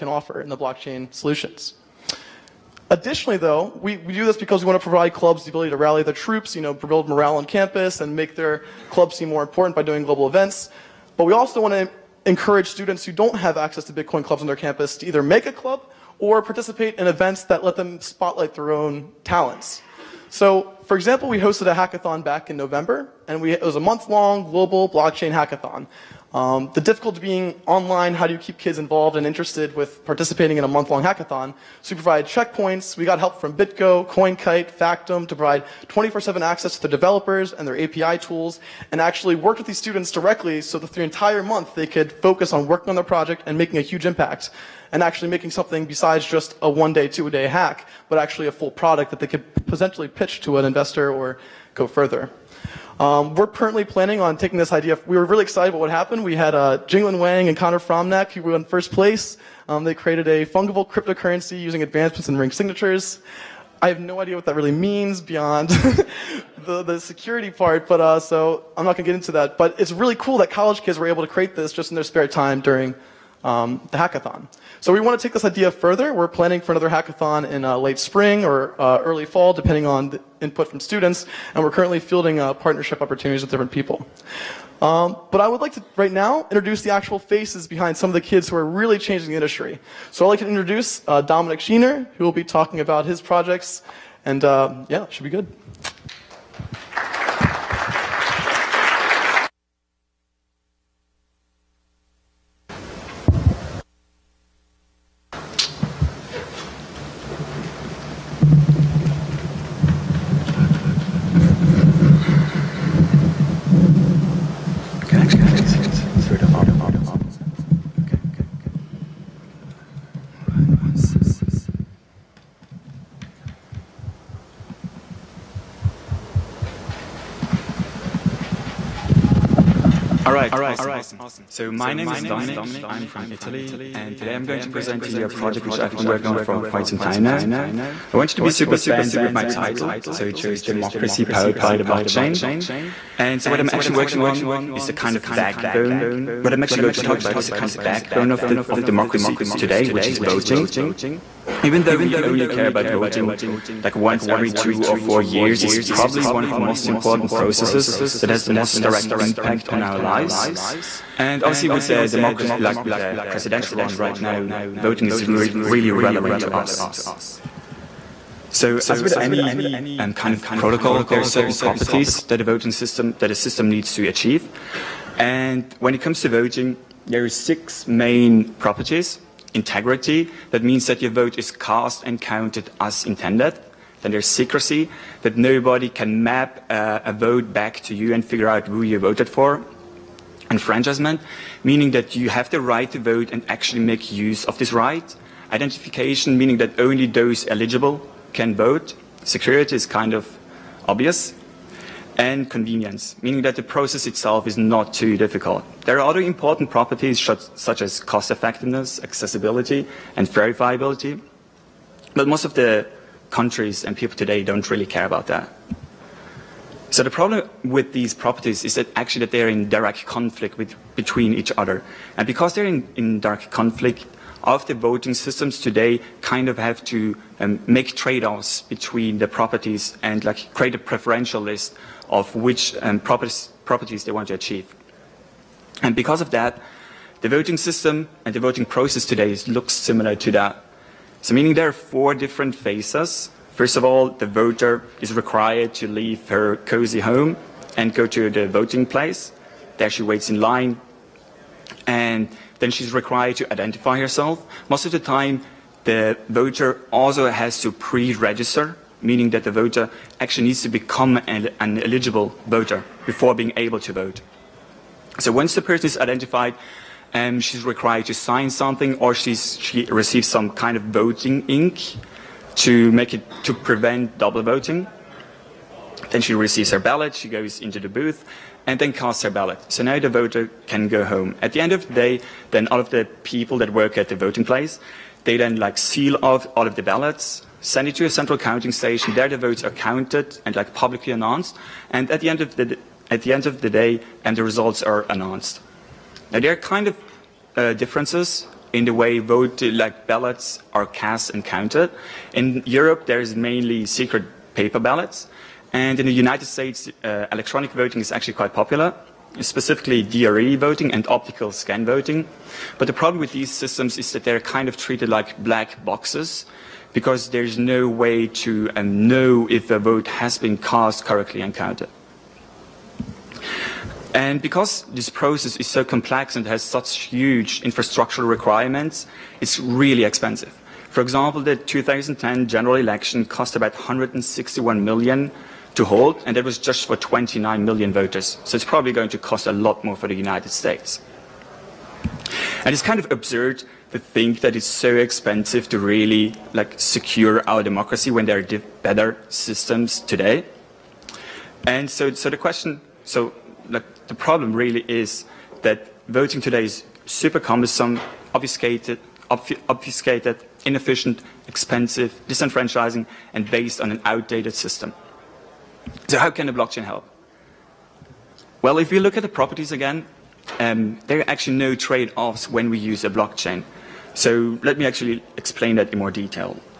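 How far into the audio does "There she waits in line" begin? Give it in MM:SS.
04:09.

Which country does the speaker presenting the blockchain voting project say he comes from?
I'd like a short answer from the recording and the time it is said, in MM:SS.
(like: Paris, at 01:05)
Italy, at 02:13.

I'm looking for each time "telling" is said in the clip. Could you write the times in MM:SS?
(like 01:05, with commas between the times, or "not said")
not said.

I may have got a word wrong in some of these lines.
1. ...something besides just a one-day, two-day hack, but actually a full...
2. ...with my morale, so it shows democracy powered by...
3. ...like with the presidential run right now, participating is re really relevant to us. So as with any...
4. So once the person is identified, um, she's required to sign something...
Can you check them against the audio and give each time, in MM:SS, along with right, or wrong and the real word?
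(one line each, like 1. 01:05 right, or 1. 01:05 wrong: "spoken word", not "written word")
1. 00:45 right
2. 02:19 wrong: "title", not "morale"
3. 02:42 wrong: "voting", not "participating"
4. 04:25 right.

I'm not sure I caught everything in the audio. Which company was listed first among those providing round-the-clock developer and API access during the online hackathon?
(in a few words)
BitGo.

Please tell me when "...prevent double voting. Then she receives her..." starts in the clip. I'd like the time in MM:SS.
04:33.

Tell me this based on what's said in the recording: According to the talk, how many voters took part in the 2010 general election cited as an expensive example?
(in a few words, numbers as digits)
29 million.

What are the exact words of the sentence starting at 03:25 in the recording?
There are other important properties such as cost effectiveness, accessibility, and verifiability.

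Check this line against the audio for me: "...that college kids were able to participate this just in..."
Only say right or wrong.
wrong.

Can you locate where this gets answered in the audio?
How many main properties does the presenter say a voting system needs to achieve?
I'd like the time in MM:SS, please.
02:57.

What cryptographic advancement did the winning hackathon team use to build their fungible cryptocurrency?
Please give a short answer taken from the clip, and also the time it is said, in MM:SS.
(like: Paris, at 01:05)
ring signatures, at 01:02.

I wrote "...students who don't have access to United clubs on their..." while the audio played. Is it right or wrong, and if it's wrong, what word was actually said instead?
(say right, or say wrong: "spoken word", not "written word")
wrong: "Bitcoin", not "United".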